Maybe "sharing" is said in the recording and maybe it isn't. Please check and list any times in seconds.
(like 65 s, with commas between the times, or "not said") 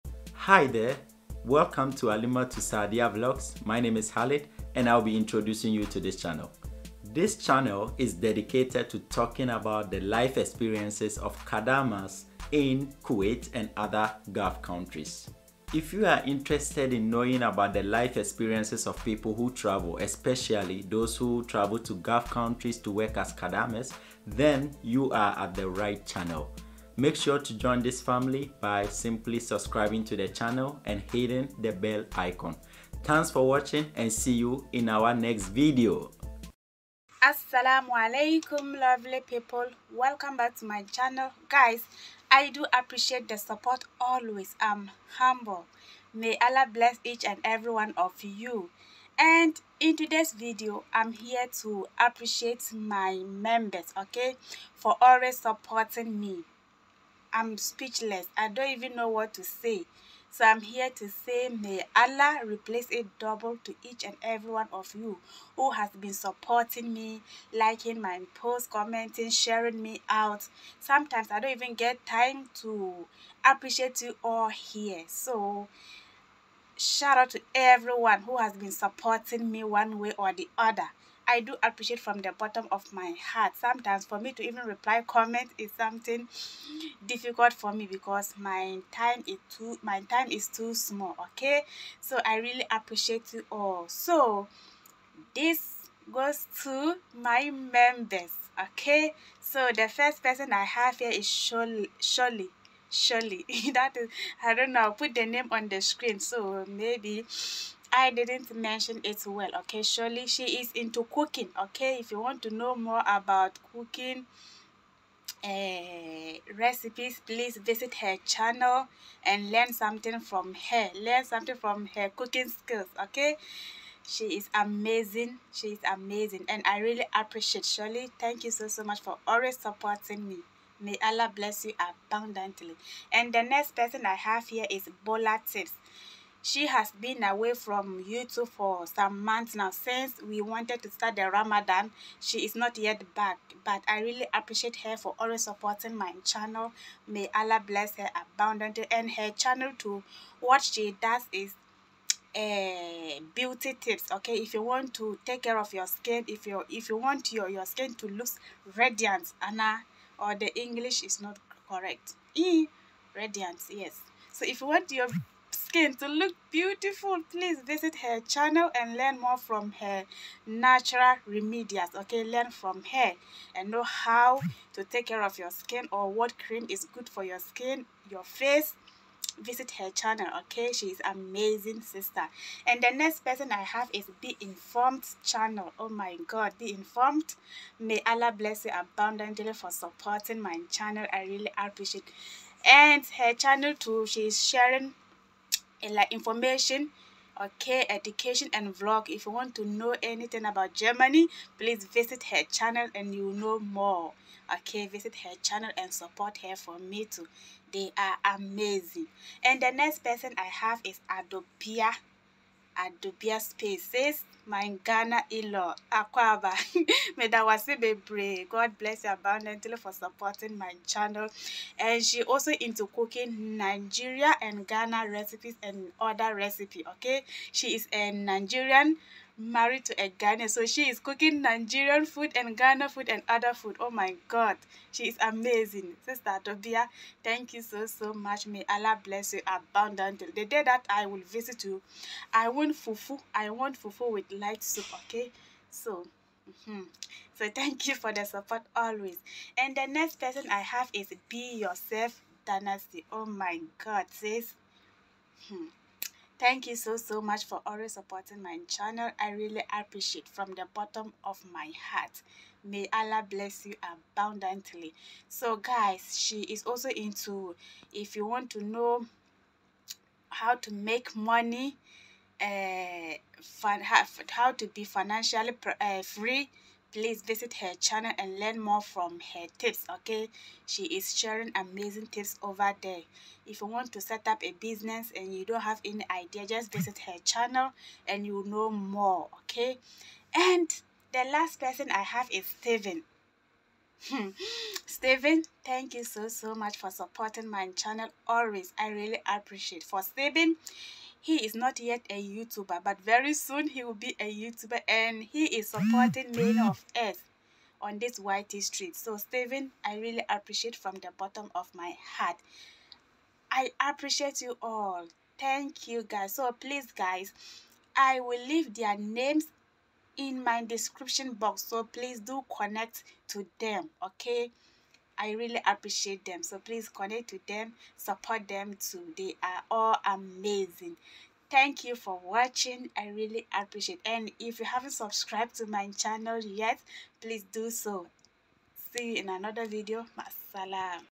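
69 s, 194 s, 281 s.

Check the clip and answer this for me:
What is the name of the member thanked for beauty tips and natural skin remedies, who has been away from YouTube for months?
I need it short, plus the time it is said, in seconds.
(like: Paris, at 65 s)
Bola Tips, at 135 s.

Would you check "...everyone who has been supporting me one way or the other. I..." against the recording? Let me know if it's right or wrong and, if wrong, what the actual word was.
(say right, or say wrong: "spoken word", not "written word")
right.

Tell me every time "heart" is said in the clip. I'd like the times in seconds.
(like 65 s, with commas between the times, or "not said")
83 s, 261 s, 312 s.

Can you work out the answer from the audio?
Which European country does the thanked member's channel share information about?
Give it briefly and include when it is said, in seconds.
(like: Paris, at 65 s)
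Germany, at 200 s.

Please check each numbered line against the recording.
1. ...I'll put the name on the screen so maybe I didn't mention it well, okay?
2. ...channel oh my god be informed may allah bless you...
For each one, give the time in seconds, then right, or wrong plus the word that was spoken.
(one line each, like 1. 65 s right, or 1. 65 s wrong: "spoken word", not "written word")
1. 104 s right
2. 185 s right.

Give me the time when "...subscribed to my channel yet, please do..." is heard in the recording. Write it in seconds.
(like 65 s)
334 s.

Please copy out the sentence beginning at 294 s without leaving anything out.
Stephen, thank you so so much for supporting my channel always.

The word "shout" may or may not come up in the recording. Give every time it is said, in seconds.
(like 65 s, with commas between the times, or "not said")
76 s.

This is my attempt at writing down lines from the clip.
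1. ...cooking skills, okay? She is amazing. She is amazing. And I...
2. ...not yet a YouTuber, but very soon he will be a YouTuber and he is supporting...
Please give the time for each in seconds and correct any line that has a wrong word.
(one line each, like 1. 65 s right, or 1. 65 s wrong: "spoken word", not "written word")
1. 122 s right
2. 301 s right.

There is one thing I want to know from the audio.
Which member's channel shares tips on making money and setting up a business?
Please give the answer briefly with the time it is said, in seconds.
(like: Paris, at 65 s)
Be Yourself Dynasty, at 251 s.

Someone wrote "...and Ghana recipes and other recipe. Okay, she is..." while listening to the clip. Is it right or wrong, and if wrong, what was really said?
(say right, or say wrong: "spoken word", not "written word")
right.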